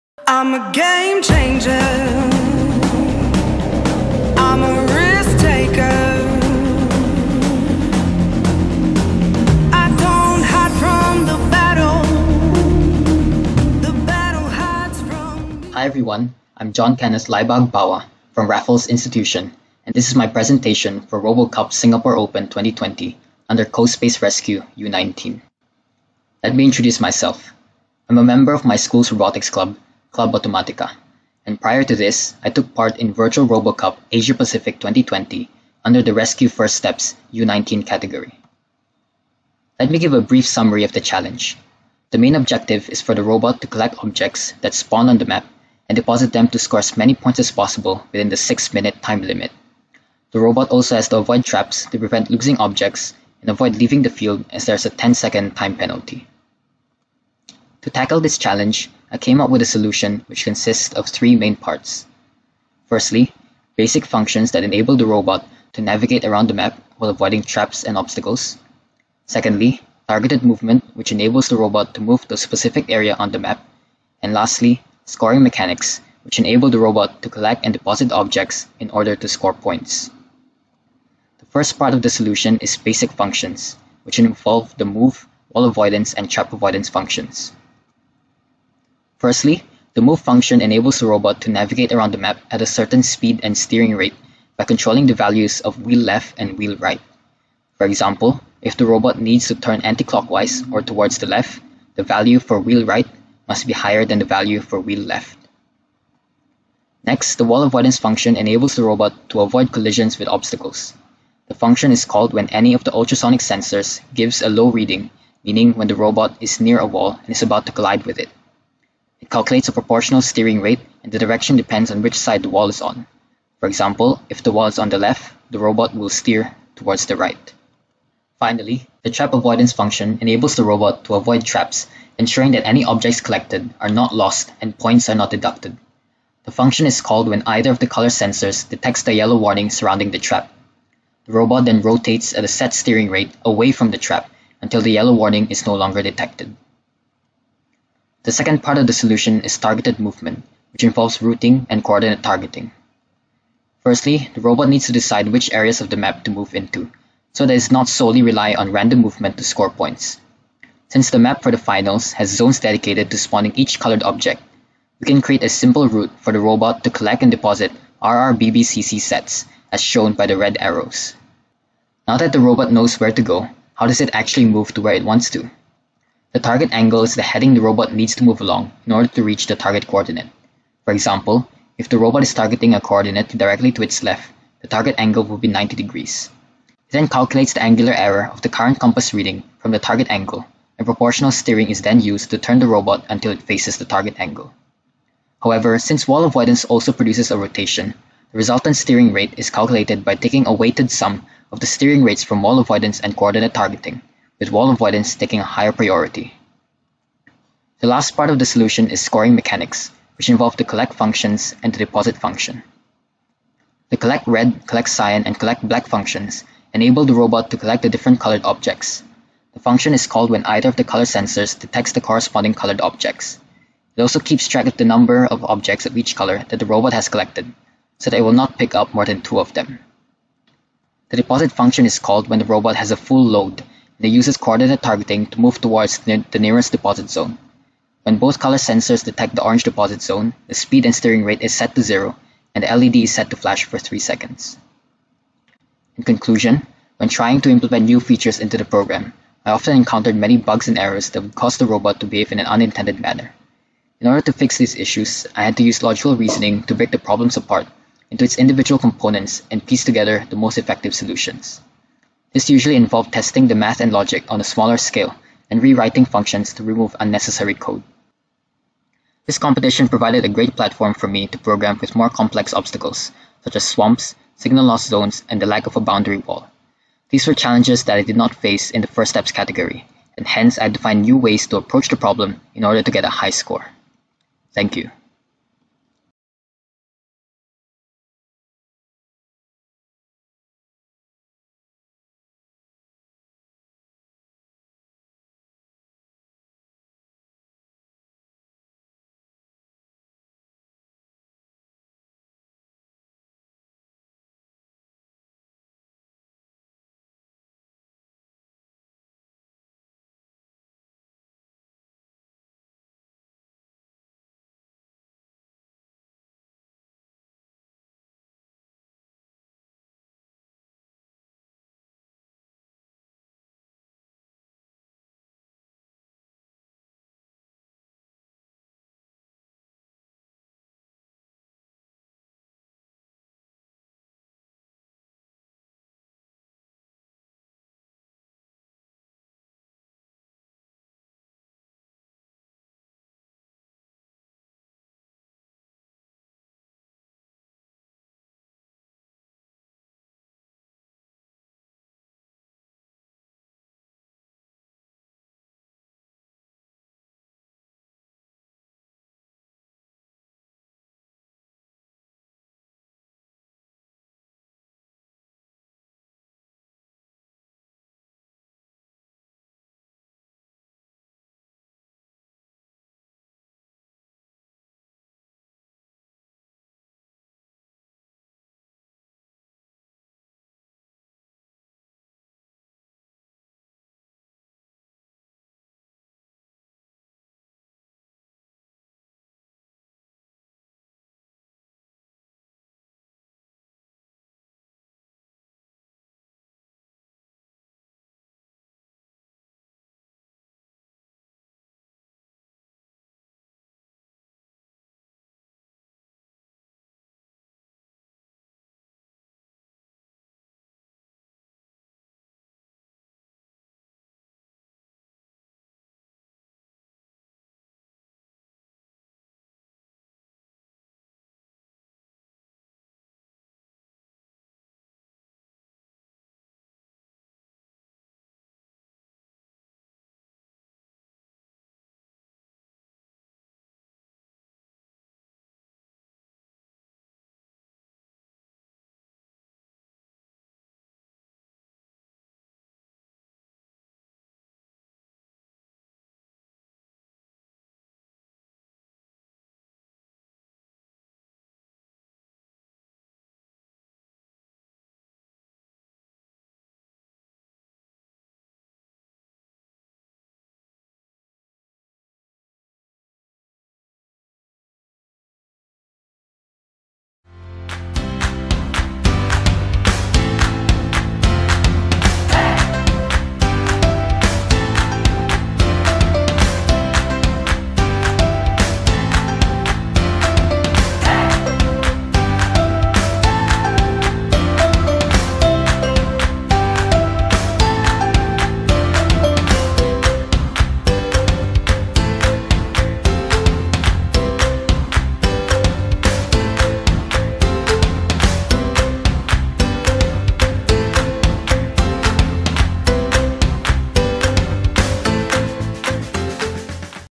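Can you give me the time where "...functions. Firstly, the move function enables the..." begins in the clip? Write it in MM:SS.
01:26.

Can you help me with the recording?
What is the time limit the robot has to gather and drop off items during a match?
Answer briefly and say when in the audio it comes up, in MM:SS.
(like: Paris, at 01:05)
6 minutes, at 00:48.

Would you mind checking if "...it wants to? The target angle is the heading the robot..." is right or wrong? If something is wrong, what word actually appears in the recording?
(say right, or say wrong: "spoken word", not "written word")
right.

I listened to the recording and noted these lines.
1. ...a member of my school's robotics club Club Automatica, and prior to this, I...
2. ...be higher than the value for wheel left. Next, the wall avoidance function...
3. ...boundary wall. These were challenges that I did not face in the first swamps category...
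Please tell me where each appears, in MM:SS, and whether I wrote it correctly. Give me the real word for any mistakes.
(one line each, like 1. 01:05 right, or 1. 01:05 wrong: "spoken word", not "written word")
1. 00:28 right
2. 01:43 right
3. 04:35 wrong: "steps", not "swamps".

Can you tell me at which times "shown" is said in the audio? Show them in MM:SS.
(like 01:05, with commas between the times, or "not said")
02:49.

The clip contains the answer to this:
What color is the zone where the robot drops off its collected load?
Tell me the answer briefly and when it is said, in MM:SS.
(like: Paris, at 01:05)
orange, at 03:59.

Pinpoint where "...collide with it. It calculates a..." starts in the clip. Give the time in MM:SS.
01:57.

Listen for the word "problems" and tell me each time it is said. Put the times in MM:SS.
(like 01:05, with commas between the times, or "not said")
04:16, 04:41.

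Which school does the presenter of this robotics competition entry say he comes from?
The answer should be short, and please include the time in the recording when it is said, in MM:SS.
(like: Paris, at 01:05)
Raffles Institution, at 00:18.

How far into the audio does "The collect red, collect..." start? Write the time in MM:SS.
03:33.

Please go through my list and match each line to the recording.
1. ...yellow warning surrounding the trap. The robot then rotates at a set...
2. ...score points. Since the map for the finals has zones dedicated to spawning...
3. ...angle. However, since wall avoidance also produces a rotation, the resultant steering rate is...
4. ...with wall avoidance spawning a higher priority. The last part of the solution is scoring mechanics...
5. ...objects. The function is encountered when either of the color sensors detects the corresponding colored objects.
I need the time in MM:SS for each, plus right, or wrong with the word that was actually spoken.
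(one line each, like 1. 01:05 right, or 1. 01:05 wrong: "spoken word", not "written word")
1. 02:19 right
2. 02:39 right
3. 03:14 right
4. 03:24 wrong: "taking", not "spawning"
5. 03:38 wrong: "called", not "encountered".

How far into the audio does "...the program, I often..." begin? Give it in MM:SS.
04:08.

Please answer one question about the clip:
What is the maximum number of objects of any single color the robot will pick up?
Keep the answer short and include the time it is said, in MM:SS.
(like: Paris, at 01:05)
2, at 03:49.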